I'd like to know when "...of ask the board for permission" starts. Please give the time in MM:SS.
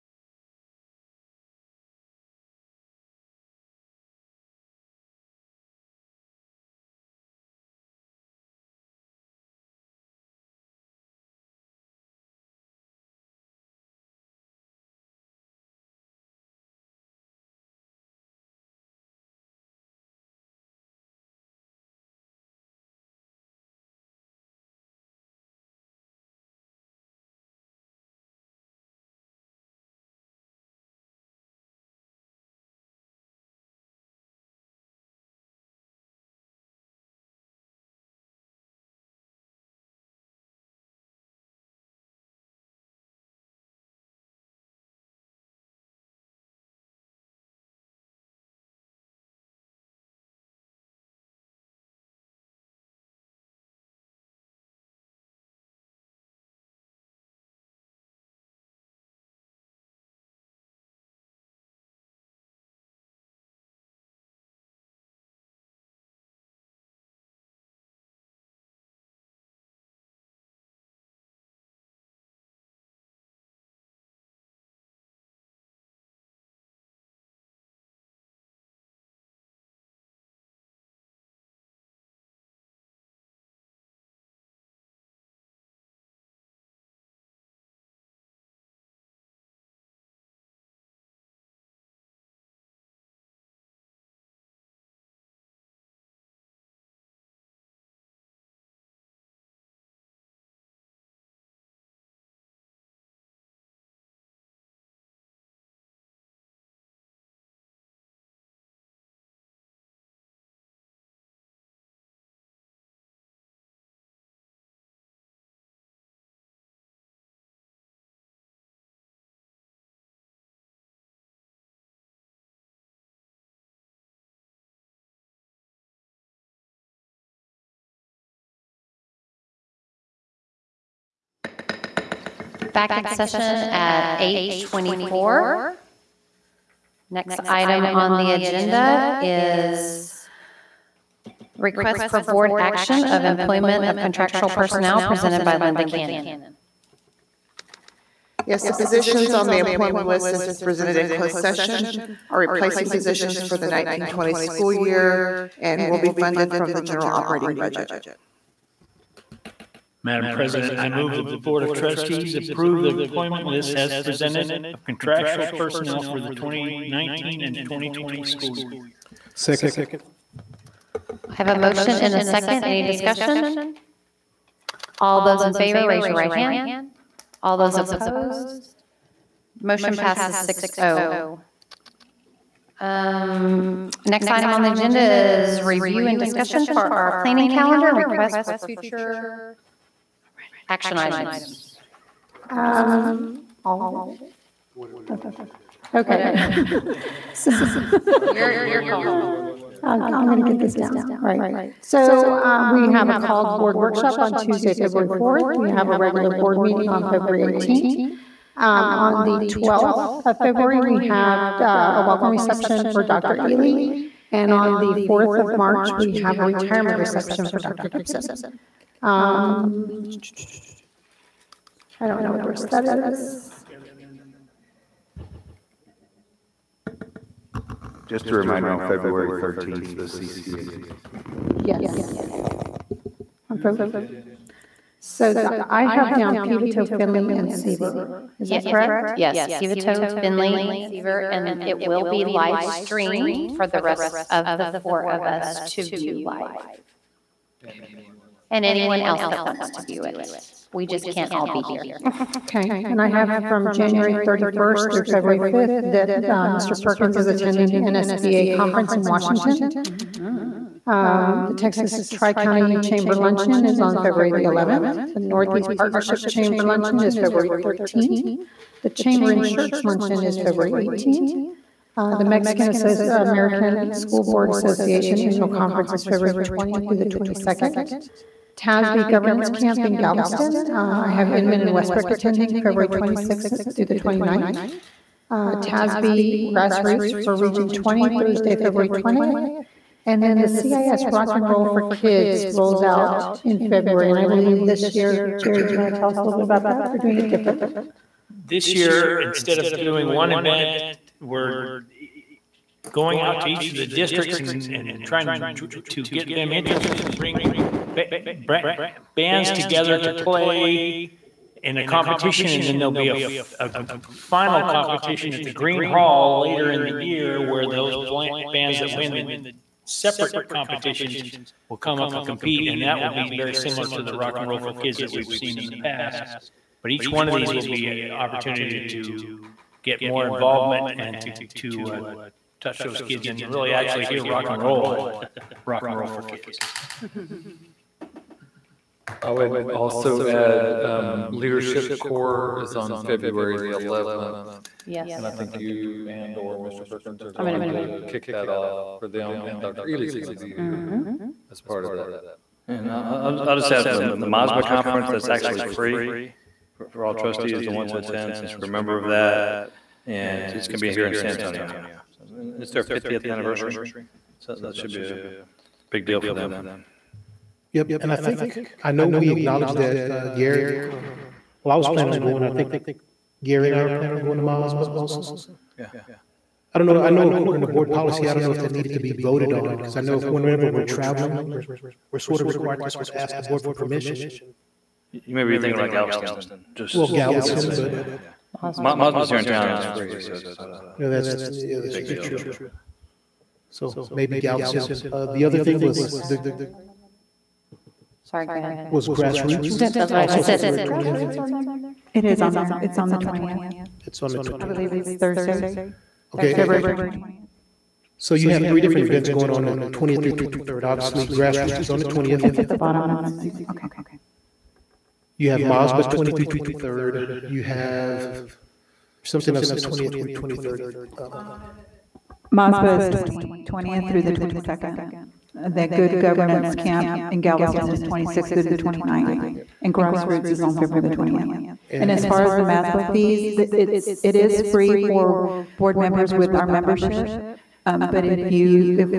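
06:23.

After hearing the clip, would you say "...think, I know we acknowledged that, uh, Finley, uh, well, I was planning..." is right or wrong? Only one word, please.
wrong.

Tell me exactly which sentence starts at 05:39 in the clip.
I would also add um, Leadership Corps is on February the 11th.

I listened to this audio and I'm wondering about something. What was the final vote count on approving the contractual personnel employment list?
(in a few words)
6-0.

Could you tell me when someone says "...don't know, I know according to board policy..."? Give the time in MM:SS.
06:16.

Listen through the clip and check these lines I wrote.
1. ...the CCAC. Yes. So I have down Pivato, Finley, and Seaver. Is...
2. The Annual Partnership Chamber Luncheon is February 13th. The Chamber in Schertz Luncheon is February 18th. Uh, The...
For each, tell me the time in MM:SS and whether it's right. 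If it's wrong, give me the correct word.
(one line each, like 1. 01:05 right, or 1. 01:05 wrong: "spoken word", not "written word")
1. 03:49 right
2. 04:25 wrong: "Northeast", not "Annual".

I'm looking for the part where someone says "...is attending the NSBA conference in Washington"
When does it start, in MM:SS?
04:17.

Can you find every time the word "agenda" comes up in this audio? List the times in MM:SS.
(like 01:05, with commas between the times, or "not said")
02:18, 03:04.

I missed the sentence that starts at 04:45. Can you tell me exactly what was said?
Uh, TASB Grassroots for Region 20, Thursday, February 20th.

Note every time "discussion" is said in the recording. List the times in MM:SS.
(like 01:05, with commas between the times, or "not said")
02:52, 03:06.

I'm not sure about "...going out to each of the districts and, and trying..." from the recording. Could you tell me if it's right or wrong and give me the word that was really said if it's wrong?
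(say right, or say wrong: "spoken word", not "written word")
right.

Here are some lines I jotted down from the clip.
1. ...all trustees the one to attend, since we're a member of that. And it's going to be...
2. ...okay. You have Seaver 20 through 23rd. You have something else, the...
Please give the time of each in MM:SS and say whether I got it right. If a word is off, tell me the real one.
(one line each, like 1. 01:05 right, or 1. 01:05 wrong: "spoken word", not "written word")
1. 05:57 right
2. 06:53 wrong: "MASBA", not "Seaver".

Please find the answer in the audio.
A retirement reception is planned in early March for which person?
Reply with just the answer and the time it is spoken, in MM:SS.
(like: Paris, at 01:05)
Dr. Gibson, at 03:37.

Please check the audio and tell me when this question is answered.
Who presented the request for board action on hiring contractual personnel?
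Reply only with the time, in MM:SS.
02:25.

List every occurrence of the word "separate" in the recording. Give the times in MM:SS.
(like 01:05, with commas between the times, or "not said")
05:19.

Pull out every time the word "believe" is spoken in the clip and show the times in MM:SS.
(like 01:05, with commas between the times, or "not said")
04:54, 06:44.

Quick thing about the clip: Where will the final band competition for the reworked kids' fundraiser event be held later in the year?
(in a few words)
Gruene Hall.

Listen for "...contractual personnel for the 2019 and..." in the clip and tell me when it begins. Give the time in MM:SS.
02:44.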